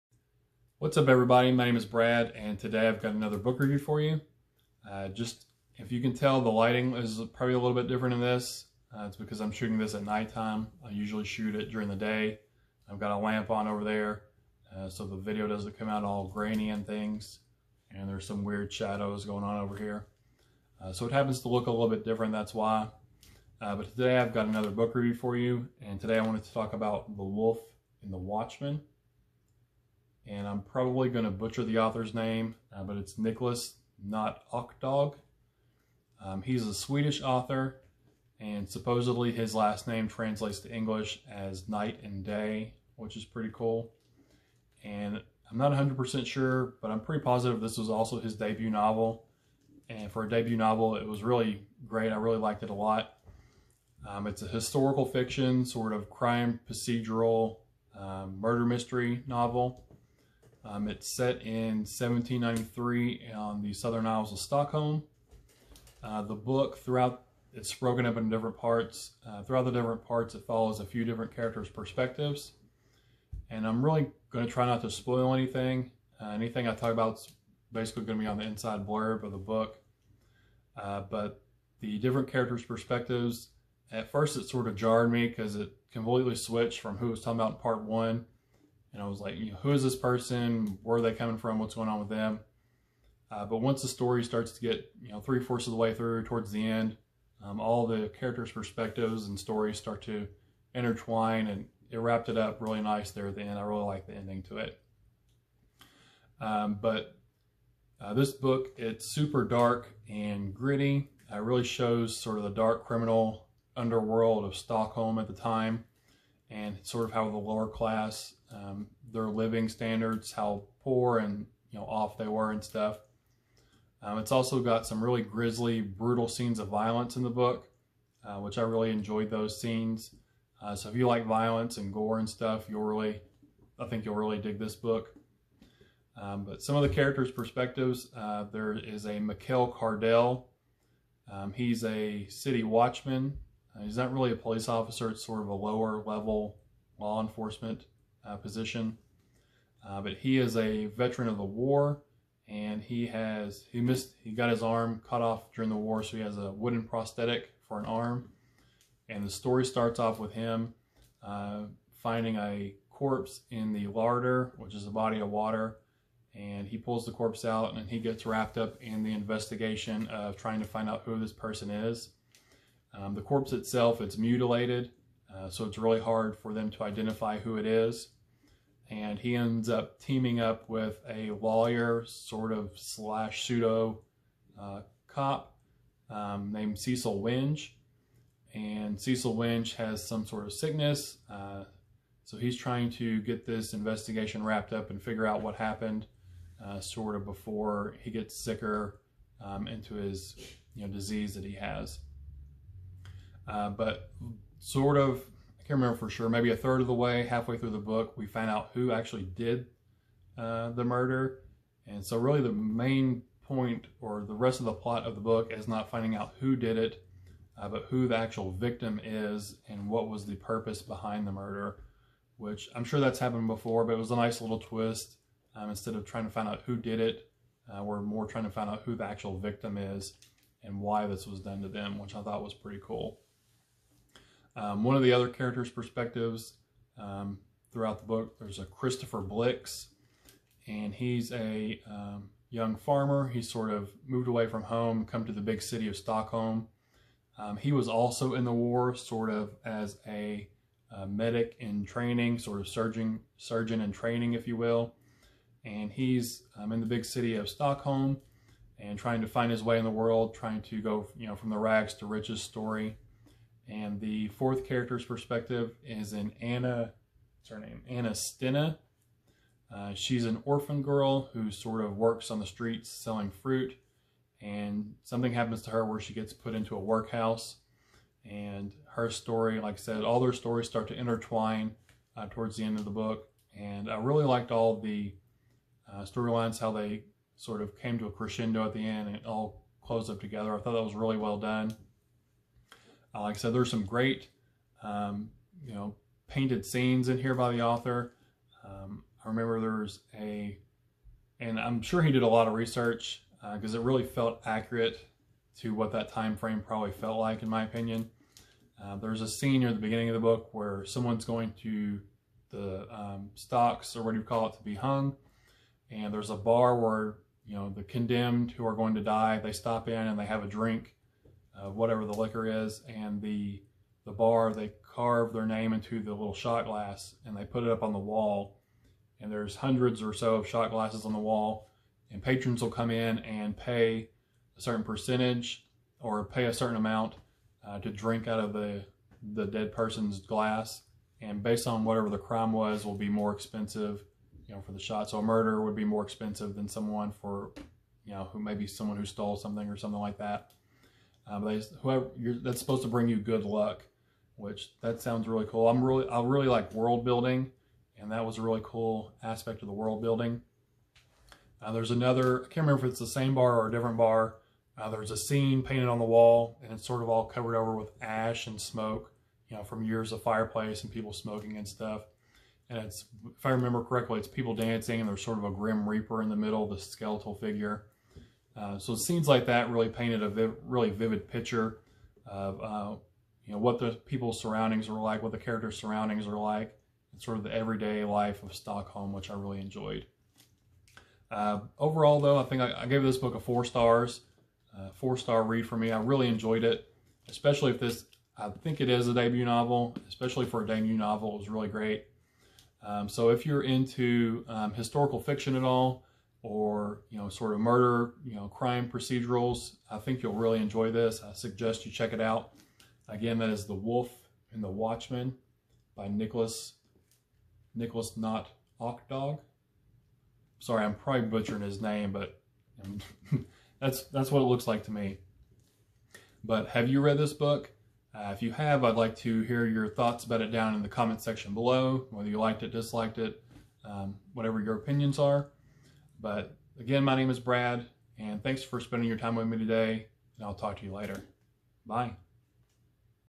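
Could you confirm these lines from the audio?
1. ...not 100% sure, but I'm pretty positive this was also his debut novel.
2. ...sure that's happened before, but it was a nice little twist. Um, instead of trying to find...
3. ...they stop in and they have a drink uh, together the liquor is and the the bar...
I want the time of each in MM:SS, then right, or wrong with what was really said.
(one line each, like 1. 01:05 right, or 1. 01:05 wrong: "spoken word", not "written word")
1. 00:45 right
2. 03:42 right
3. 05:19 wrong: "whatever", not "together".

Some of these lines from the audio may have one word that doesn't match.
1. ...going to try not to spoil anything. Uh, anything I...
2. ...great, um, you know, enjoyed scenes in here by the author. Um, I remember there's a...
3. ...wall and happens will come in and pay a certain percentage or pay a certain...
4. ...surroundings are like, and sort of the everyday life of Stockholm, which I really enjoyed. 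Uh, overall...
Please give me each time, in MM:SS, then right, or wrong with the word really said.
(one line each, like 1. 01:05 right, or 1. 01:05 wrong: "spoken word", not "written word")
1. 01:14 right
2. 04:53 wrong: "painted", not "enjoyed"
3. 05:31 wrong: "patrons", not "happens"
4. 06:25 right.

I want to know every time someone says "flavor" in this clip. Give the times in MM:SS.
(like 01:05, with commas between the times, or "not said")
not said.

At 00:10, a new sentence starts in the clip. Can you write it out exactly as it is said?
I usually shoot it during the day.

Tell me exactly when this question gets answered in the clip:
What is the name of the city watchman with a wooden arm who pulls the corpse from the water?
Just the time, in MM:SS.
02:19.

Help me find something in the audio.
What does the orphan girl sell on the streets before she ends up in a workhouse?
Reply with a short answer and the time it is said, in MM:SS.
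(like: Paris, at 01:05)
Fruit, at 04:32.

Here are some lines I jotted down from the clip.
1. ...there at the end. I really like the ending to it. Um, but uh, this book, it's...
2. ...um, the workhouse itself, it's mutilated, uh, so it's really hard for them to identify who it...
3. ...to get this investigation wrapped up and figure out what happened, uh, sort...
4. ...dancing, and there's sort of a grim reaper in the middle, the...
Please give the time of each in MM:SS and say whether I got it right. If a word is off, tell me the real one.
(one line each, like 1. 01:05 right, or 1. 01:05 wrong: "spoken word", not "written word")
1. 01:43 right
2. 02:52 wrong: "corpse", not "workhouse"
3. 03:12 right
4. 06:14 right.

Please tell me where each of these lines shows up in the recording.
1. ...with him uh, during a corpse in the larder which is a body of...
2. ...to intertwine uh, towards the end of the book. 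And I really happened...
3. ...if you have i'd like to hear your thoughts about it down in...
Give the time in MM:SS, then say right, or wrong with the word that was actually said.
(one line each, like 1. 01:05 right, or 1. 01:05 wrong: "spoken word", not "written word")
1. 02:40 wrong: "finding", not "during"
2. 04:40 wrong: "liked", not "happened"
3. 07:08 right.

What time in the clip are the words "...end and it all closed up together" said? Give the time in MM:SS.
04:48.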